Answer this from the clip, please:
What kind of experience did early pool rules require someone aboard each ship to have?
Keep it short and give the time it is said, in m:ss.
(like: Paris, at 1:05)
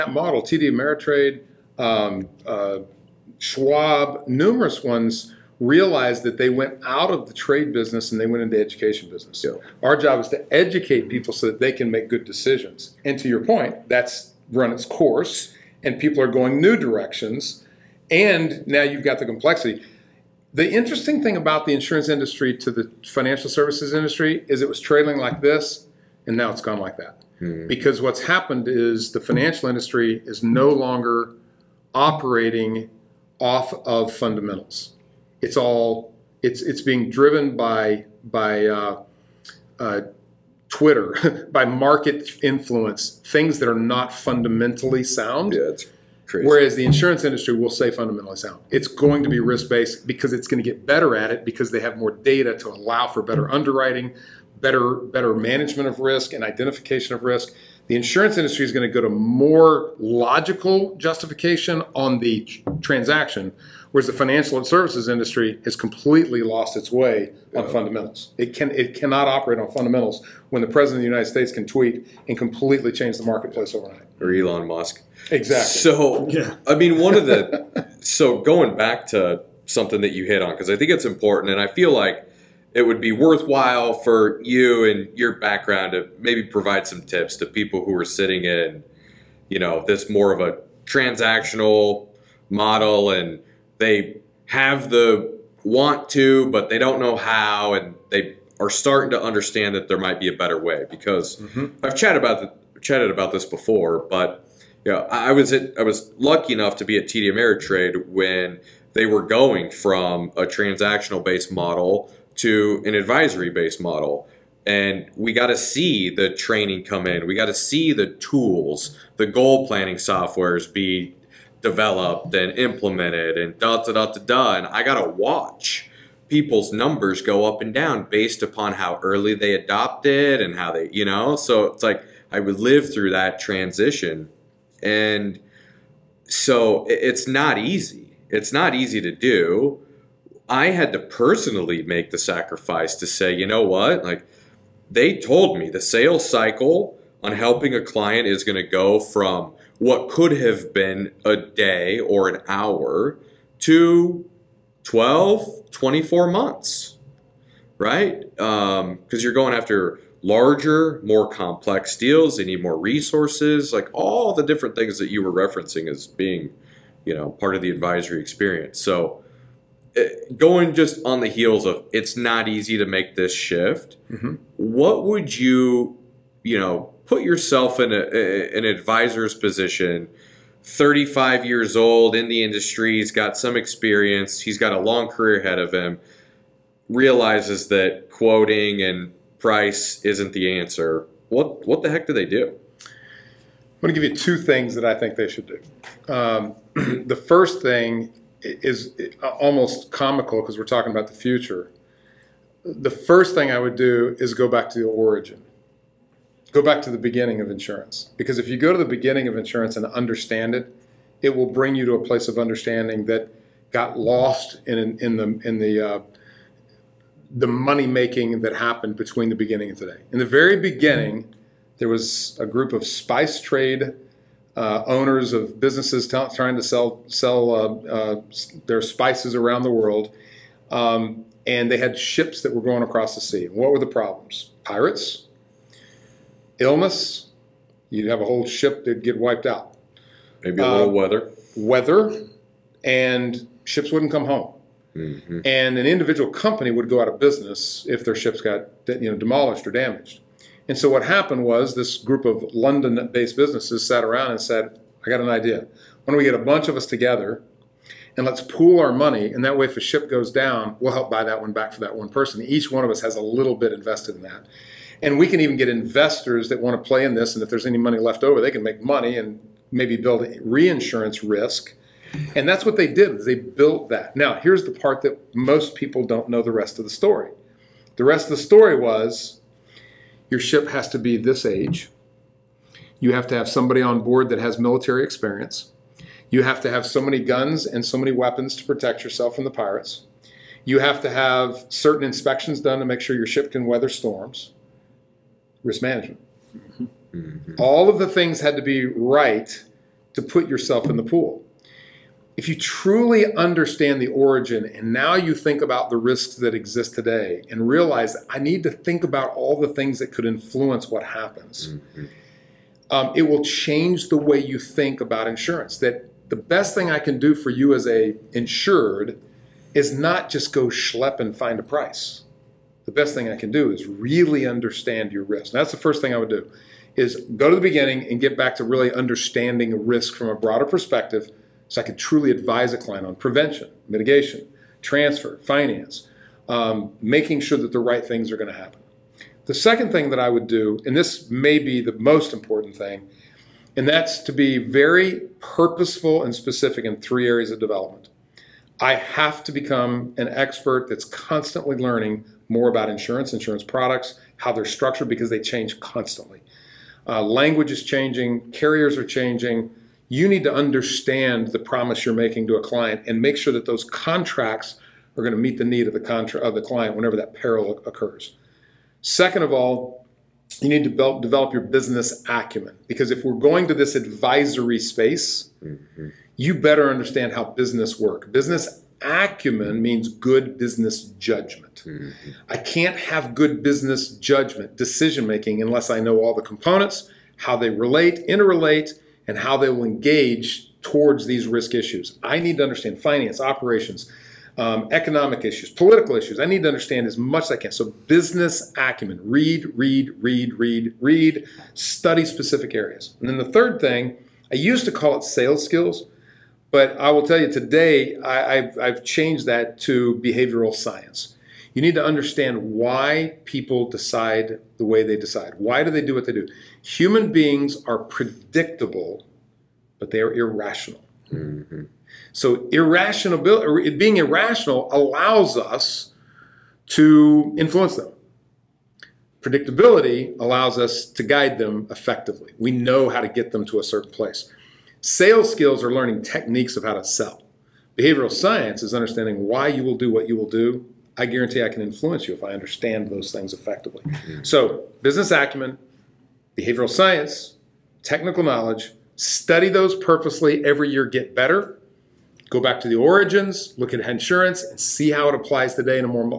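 military experience, at 4:44.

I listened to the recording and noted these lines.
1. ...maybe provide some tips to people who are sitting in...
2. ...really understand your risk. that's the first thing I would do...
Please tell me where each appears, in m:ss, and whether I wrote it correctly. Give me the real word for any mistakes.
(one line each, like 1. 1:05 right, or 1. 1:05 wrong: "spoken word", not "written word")
1. 1:26 right
2. 5:23 right.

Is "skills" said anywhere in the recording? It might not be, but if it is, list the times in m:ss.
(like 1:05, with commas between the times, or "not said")
6:45, 7:15.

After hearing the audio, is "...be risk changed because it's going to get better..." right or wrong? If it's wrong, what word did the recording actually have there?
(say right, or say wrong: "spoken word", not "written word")
wrong: "based", not "changed".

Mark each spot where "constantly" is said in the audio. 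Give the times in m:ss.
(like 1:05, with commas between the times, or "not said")
5:51, 5:55.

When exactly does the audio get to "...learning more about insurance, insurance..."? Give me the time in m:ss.
5:51.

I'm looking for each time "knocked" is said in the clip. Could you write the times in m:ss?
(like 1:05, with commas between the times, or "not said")
not said.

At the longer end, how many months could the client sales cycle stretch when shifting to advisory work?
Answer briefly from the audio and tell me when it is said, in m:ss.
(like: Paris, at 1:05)
24 months, at 2:35.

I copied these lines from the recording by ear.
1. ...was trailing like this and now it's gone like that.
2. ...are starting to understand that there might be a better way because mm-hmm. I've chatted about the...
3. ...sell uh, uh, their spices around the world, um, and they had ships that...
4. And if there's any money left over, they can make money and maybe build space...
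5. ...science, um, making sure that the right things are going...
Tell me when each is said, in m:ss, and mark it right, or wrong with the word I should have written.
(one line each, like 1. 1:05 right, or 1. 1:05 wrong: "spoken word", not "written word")
1. 0:24 right
2. 1:38 right
3. 3:47 right
4. 4:27 wrong: "reinsurance", not "space"
5. 5:35 wrong: "finance", not "science".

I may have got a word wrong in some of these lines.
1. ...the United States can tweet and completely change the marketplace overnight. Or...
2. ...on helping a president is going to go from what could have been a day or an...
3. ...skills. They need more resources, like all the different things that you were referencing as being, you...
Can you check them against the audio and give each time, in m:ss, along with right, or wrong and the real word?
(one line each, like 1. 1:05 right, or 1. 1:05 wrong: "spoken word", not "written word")
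1. 1:11 right
2. 2:27 wrong: "client", not "president"
3. 2:41 wrong: "deals", not "skills".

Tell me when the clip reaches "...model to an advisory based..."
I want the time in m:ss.
1:51.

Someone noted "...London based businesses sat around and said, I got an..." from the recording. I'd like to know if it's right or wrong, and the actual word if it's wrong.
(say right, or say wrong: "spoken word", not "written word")
right.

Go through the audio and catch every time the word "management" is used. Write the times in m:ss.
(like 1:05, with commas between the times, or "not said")
0:55, 4:55.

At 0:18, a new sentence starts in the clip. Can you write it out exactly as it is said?
And now you've got the complexity.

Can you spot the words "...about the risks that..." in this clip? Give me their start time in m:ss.
5:05.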